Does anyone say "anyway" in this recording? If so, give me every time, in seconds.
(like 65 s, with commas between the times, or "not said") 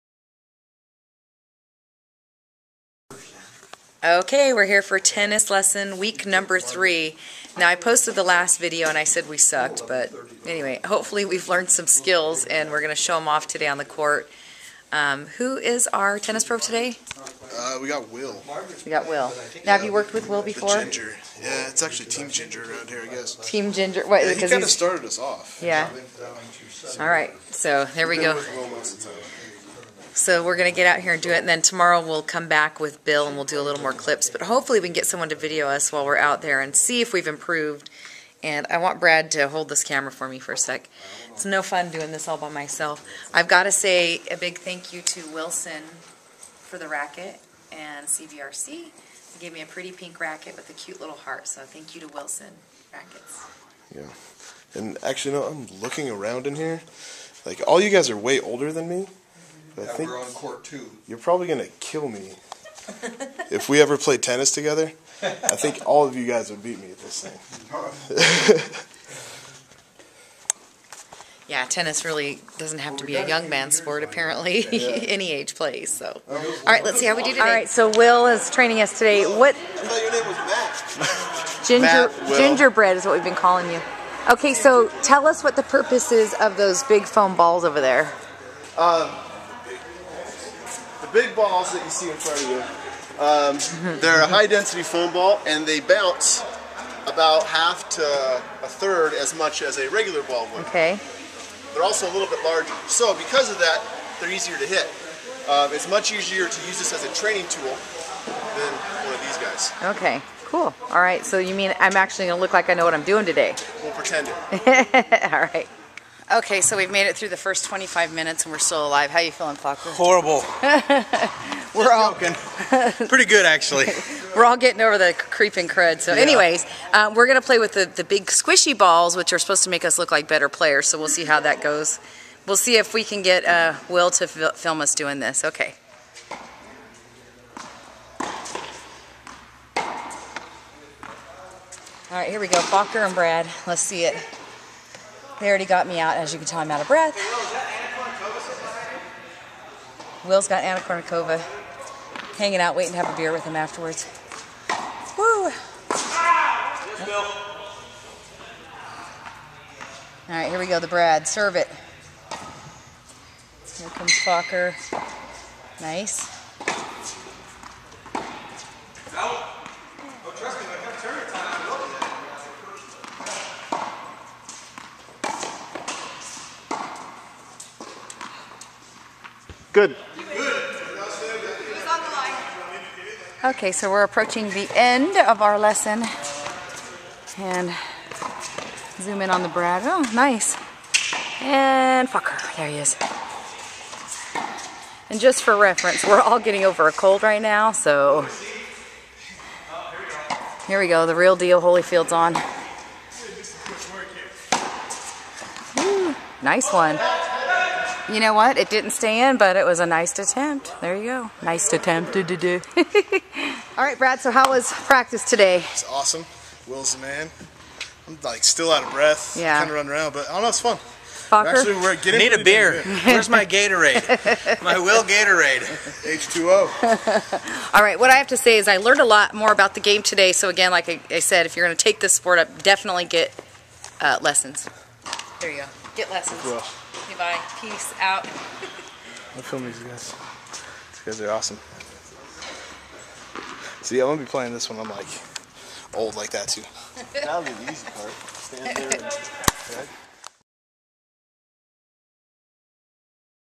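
10 s, 126 s.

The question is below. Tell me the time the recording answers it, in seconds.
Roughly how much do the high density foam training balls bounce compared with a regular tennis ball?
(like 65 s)
97 s.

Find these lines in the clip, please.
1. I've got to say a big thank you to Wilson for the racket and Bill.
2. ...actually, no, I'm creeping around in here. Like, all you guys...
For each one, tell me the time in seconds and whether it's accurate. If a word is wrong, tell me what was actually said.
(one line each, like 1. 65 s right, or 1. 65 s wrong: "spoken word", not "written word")
1. 43 s wrong: "CVRC", not "Bill"
2. 55 s wrong: "looking", not "creeping".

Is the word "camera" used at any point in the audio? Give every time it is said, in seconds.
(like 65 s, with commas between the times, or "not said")
39 s.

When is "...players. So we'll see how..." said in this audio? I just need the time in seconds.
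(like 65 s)
130 s.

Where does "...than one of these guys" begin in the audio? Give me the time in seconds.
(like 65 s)
108 s.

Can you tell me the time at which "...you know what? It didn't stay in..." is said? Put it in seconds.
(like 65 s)
208 s.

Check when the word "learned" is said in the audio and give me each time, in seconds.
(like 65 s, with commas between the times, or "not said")
11 s, 228 s.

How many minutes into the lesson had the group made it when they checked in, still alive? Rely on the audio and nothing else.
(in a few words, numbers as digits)
25.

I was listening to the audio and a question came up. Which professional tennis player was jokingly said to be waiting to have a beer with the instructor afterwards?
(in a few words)
Anna Kournikova.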